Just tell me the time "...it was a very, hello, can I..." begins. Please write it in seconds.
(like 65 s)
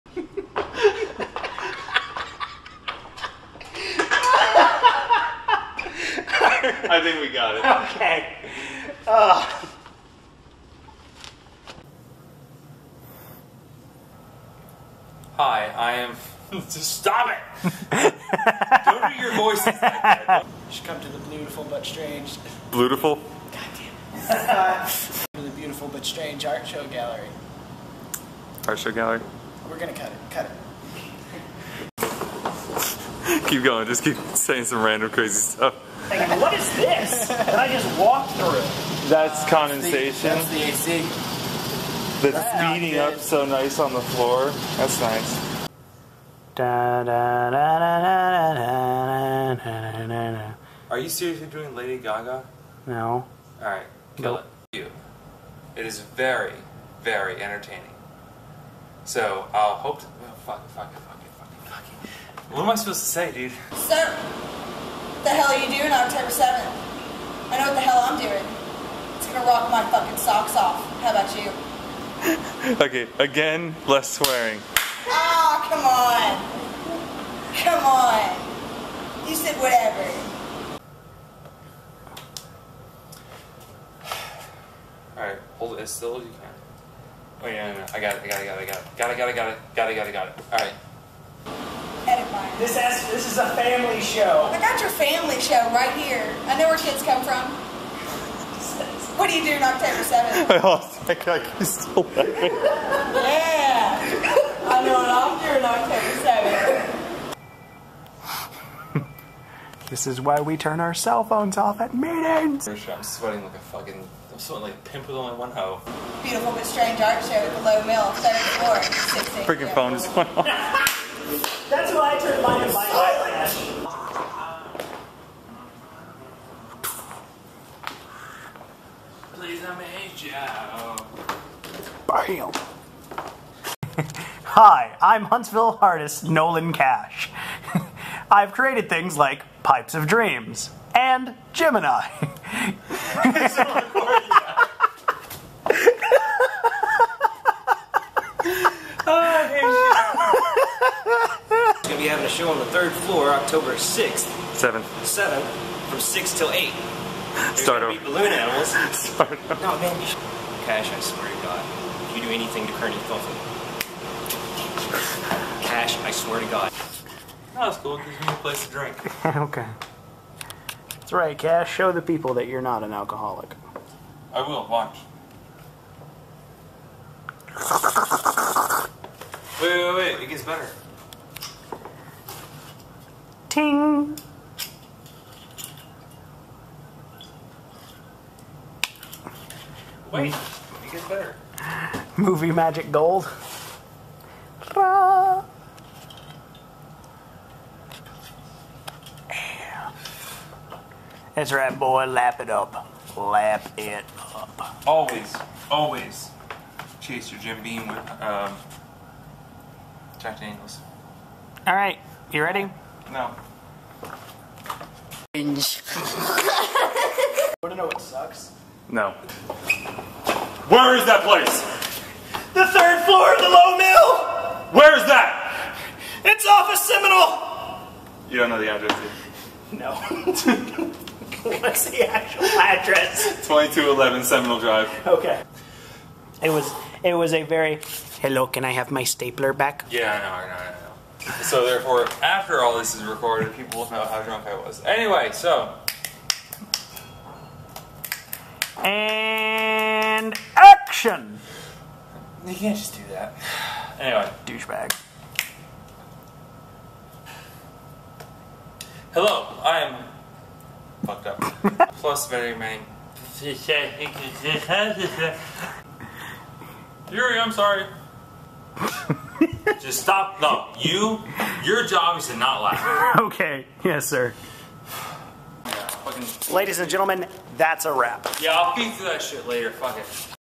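237 s.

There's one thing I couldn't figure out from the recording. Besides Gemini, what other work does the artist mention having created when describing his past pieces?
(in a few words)
Pipes of Dreams.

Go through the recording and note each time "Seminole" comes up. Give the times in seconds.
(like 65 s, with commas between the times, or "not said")
226 s, 234 s.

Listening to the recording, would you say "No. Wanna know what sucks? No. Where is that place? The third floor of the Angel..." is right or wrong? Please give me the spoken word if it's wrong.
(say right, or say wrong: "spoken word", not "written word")
wrong: "Lowe", not "Angel".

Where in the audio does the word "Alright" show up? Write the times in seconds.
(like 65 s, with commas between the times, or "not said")
85 s, 90 s.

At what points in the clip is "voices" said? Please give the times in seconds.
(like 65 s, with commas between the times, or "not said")
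19 s.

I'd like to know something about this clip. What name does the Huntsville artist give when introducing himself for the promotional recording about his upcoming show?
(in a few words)
Nolan Cash.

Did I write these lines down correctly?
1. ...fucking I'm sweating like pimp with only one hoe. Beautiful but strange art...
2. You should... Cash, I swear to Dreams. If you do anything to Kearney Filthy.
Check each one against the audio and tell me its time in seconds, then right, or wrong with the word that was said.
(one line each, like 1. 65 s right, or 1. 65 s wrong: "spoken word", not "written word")
1. 113 s right
2. 159 s wrong: "God", not "Dreams".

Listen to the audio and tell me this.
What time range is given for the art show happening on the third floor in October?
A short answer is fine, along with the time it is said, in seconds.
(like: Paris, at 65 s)
6 till 8, at 155 s.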